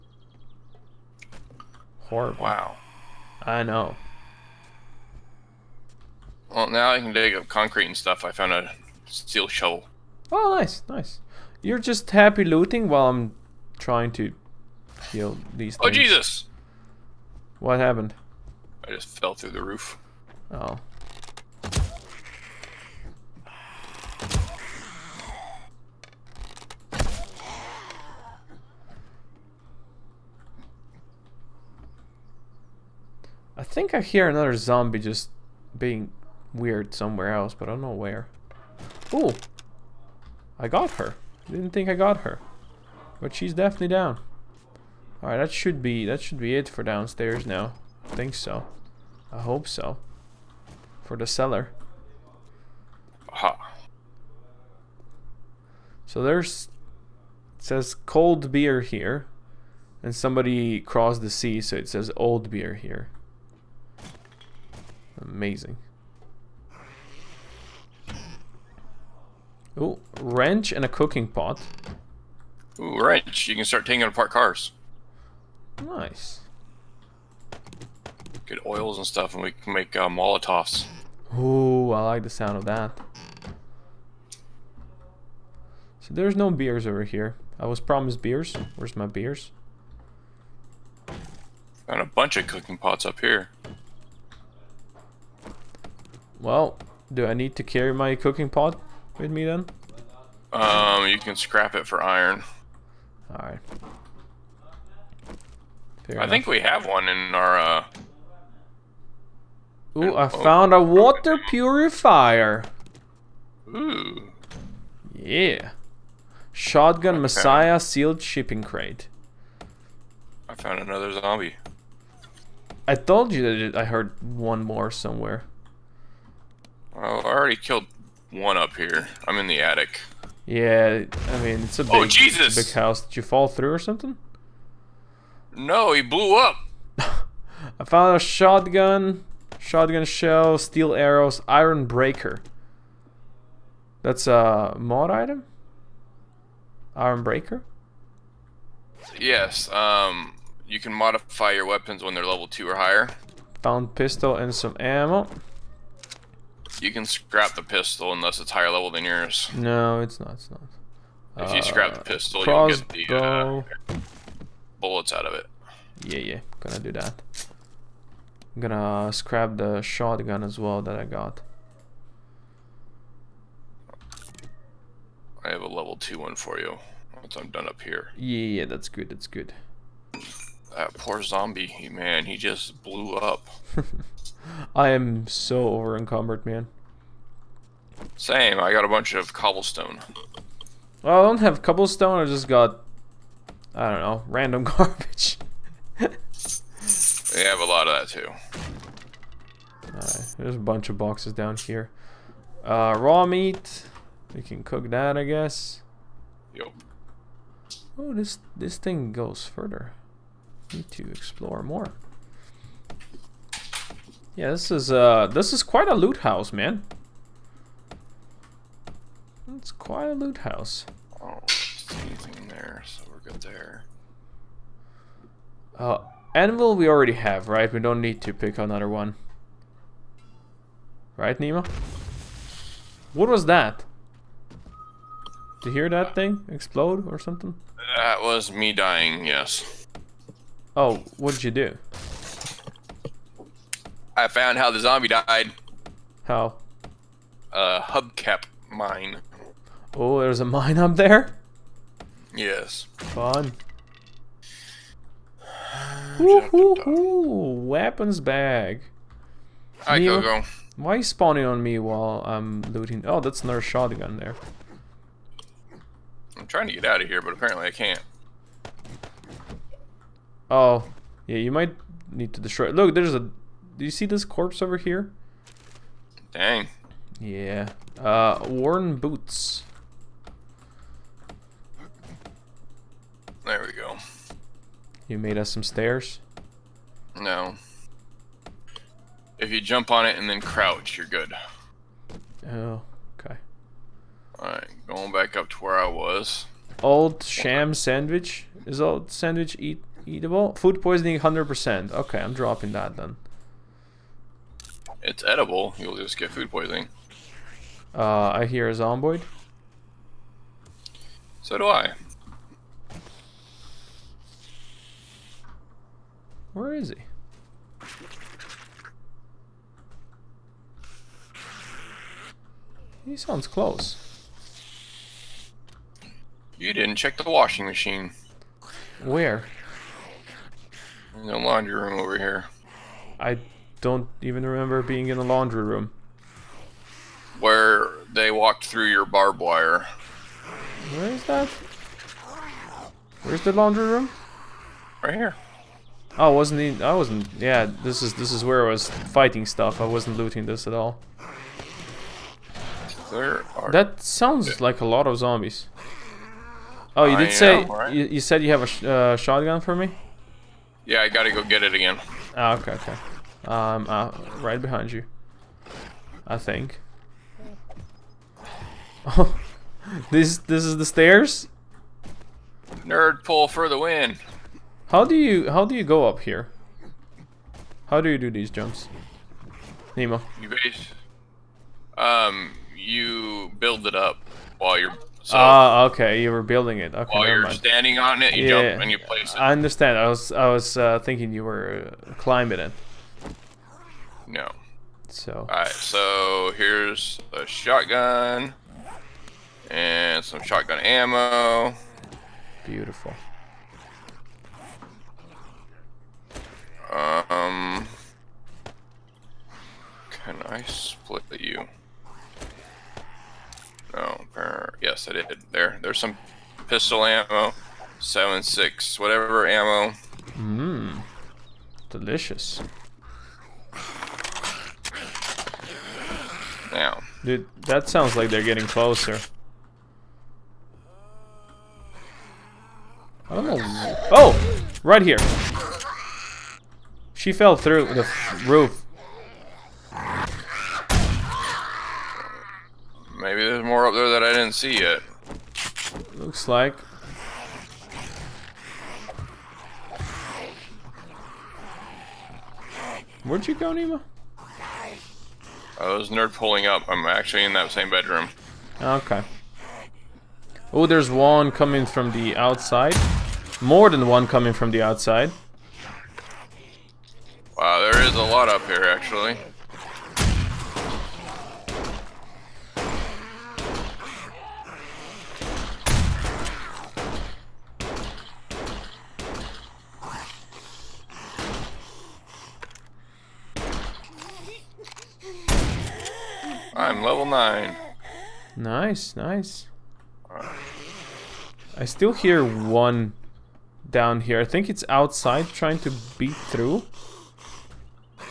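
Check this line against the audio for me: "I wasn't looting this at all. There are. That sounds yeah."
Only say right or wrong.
right.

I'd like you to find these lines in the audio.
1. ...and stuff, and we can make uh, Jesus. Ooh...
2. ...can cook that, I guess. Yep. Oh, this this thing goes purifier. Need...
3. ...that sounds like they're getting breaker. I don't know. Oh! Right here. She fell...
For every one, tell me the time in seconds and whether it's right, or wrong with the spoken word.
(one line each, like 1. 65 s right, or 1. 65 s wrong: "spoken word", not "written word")
1. 78 s wrong: "Molotovs", not "Jesus"
2. 204 s wrong: "further", not "purifier"
3. 427 s wrong: "closer", not "breaker".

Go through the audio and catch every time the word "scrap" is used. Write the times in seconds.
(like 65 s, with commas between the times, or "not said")
101 s, 157 s, 161 s, 169 s.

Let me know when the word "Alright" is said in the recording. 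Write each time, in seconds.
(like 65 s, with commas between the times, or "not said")
45 s, 103 s, 294 s, 395 s.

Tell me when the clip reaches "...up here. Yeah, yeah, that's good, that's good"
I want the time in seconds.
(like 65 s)
177 s.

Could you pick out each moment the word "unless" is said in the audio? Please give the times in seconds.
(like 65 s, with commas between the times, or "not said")
158 s.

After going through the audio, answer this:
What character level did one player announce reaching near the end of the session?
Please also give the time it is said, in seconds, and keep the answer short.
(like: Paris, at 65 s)
9, at 487 s.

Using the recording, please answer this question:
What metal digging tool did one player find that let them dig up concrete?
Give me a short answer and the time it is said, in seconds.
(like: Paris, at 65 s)
Steel shovel, at 9 s.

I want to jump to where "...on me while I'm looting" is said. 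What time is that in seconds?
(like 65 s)
261 s.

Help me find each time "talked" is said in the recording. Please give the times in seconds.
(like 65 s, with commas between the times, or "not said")
not said.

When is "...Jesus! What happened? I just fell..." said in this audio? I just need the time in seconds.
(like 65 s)
16 s.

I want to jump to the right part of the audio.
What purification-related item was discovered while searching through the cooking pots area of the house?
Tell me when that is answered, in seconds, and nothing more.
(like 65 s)
110 s.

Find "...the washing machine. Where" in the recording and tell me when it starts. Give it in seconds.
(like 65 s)
327 s.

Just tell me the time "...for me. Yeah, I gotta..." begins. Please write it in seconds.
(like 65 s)
359 s.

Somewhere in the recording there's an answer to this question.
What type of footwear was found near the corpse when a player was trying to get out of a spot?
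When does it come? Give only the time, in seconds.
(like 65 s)
278 s.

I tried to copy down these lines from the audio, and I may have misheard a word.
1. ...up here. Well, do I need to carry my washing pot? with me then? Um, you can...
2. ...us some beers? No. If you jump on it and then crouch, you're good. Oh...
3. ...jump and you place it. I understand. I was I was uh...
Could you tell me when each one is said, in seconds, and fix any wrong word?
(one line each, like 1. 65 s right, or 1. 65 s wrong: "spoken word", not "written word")
1. 93 s wrong: "cooking", not "washing"
2. 285 s wrong: "stairs", not "beers"
3. 388 s right.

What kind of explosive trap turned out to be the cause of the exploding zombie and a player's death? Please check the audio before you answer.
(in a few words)
Hubcap mine.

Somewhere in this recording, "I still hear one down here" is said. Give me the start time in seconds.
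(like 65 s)
491 s.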